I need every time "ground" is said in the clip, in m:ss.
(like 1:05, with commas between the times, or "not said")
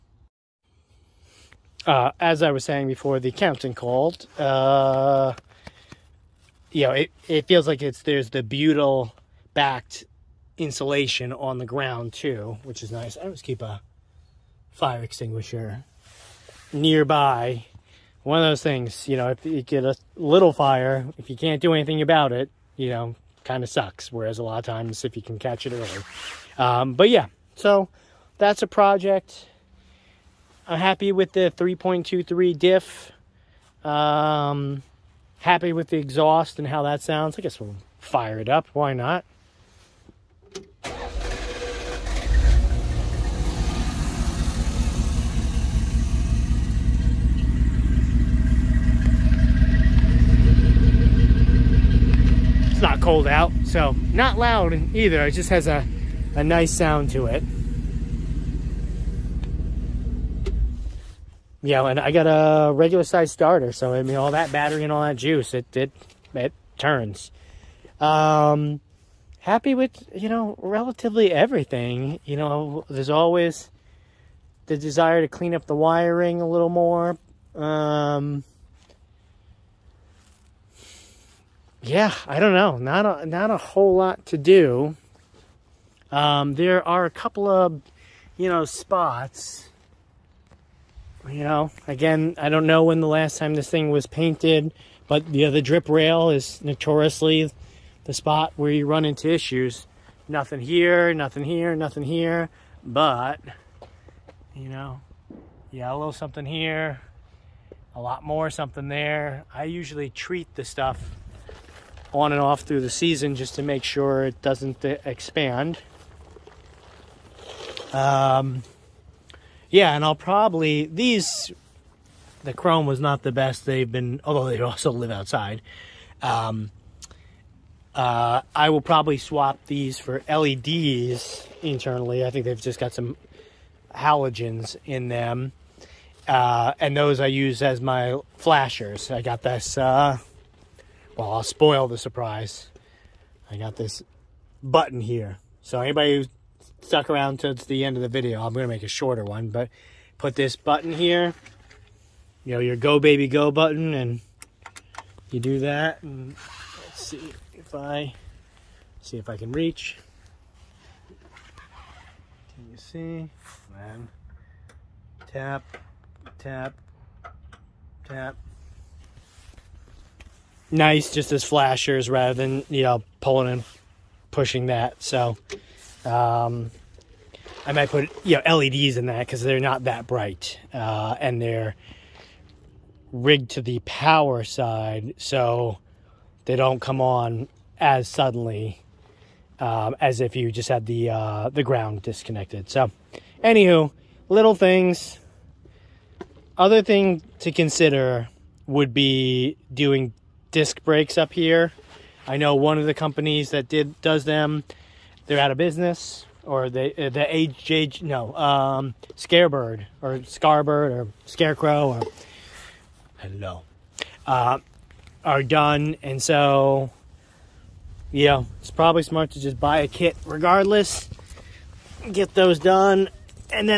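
0:11, 3:11.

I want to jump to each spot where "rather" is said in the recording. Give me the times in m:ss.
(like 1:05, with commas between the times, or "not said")
2:52.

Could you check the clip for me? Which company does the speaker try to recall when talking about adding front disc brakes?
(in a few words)
Scarebird.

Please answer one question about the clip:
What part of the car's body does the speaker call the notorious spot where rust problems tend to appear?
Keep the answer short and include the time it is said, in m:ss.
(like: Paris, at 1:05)
drip rail, at 1:35.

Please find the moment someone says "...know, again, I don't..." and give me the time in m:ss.
1:31.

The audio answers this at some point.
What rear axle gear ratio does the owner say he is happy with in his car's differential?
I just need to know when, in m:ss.
0:31.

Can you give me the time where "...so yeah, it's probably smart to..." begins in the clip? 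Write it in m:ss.
3:36.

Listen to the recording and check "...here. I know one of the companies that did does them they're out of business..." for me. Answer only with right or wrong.
right.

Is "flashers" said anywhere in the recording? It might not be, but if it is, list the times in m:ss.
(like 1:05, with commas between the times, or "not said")
2:18, 2:51.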